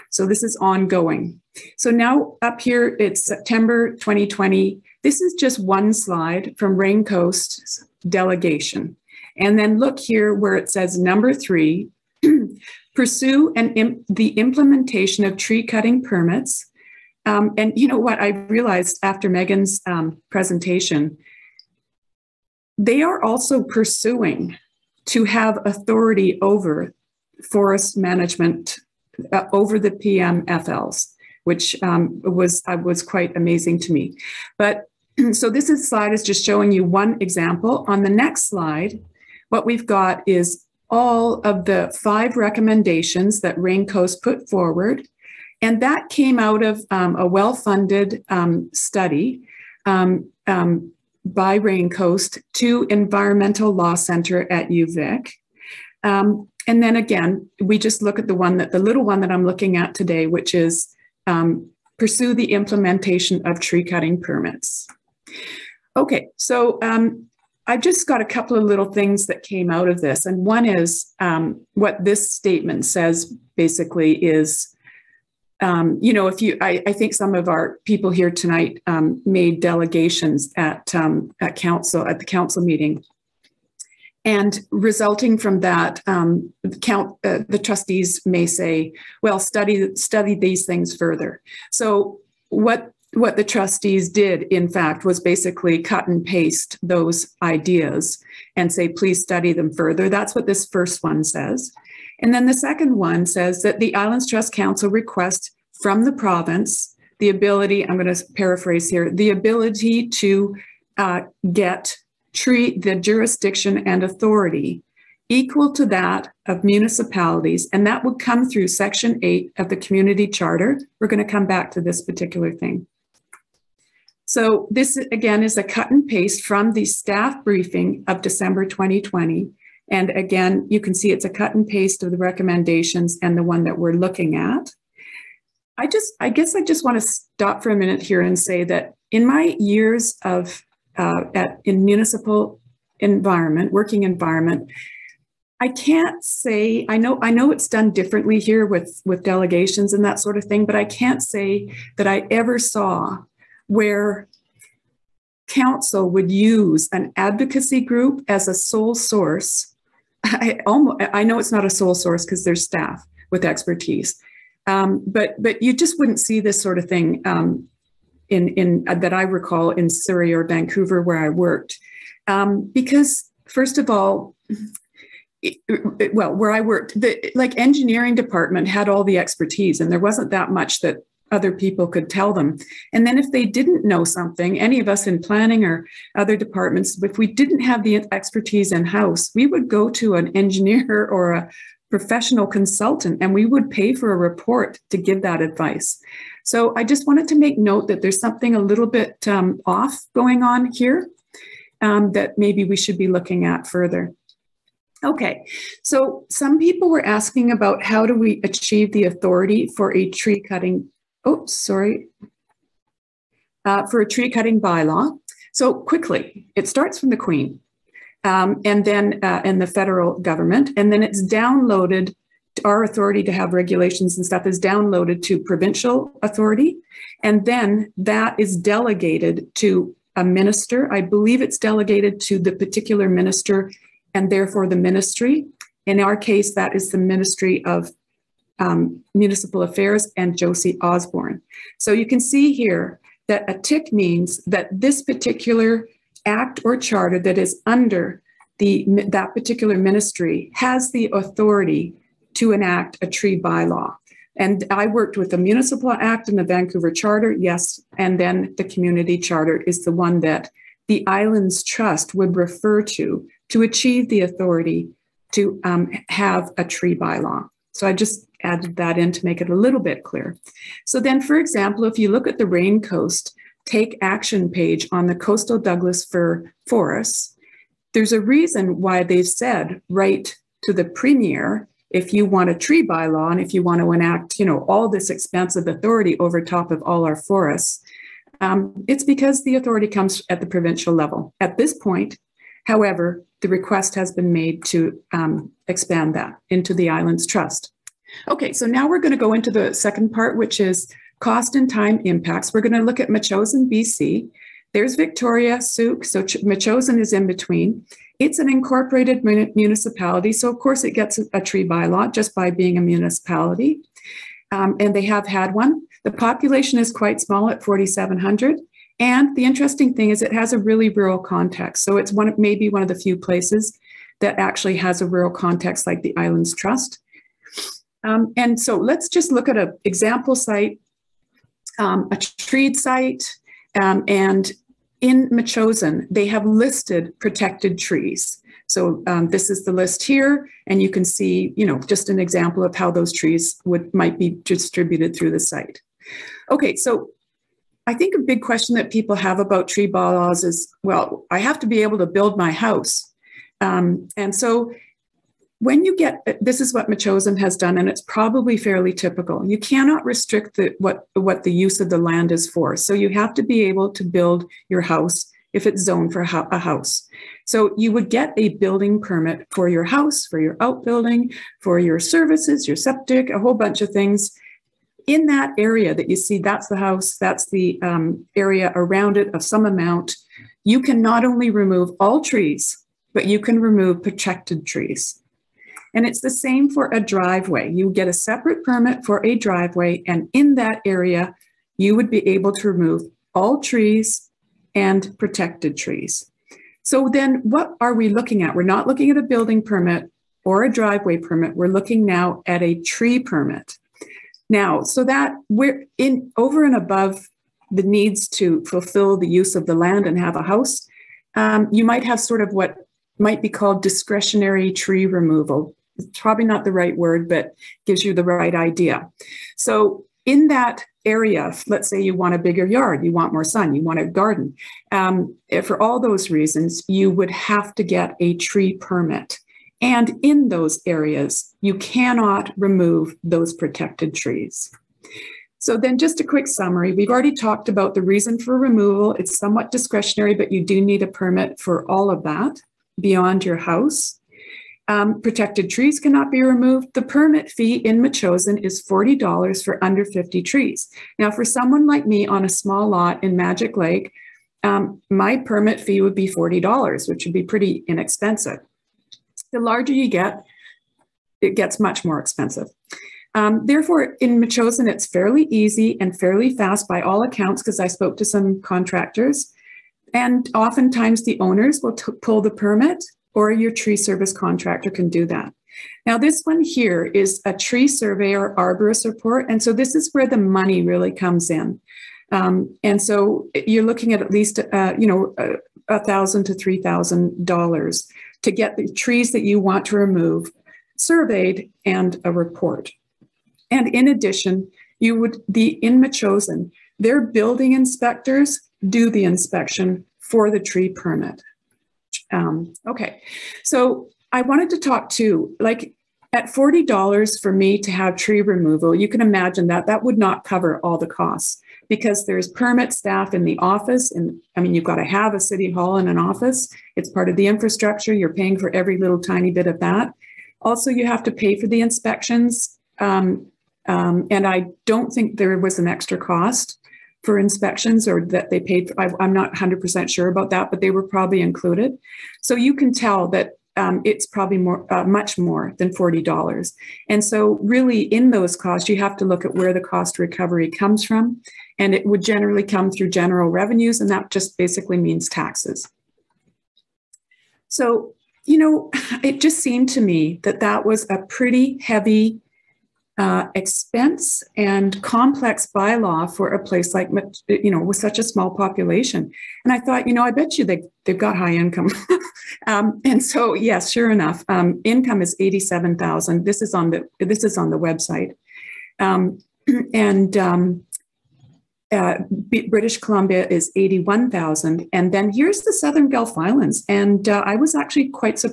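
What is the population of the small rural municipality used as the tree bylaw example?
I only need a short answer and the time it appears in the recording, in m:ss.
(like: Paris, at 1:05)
4,700, at 5:17.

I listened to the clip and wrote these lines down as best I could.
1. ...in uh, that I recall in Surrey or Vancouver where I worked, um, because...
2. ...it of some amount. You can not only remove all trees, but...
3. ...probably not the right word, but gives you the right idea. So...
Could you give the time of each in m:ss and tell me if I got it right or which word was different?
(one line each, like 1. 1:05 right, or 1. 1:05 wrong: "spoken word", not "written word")
1. 2:48 right
2. 6:19 right
3. 6:56 right.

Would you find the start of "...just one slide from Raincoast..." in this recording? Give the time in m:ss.
0:05.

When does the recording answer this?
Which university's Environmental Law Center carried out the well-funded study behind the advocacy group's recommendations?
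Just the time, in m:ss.
0:54.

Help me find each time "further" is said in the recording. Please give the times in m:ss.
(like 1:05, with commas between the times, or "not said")
1:30, 1:39, 3:23.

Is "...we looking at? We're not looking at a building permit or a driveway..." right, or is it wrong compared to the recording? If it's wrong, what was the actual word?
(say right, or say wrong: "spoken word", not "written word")
right.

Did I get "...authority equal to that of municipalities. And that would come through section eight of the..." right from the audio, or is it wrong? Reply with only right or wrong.
right.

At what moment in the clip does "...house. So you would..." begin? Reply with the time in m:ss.
6:06.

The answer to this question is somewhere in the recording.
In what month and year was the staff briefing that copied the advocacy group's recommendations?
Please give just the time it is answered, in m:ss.
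2:08.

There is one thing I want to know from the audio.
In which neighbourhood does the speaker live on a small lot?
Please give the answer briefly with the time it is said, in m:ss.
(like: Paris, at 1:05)
Magic Lake, at 7:33.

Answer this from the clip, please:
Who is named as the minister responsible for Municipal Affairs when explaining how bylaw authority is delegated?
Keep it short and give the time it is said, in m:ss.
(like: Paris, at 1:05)
Josie Osborne, at 4:00.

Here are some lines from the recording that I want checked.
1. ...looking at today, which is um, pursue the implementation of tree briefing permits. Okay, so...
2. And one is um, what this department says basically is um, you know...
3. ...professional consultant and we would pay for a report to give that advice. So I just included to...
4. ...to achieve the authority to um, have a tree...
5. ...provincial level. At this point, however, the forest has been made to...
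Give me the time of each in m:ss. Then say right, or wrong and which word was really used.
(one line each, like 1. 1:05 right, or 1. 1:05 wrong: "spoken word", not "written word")
1. 0:59 wrong: "cutting", not "briefing"
2. 1:10 wrong: "statement", not "department"
3. 3:11 wrong: "wanted", not "included"
4. 4:23 right
5. 4:50 wrong: "request", not "forest".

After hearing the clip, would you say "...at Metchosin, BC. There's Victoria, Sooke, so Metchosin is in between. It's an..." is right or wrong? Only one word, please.
right.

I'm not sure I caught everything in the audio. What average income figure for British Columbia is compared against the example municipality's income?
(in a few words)
81,000.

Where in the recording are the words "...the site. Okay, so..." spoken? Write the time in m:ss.
5:45.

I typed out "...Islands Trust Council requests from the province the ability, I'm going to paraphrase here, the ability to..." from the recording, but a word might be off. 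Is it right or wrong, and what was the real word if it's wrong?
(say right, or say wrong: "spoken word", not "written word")
right.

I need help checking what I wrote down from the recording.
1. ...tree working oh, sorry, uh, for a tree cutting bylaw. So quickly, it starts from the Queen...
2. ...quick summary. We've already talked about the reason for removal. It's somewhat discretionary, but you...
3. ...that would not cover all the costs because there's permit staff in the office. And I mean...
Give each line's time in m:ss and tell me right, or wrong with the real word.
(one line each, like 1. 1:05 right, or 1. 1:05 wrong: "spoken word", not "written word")
1. 3:30 wrong: "cutting", not "working"
2. 7:16 right
3. 8:29 right.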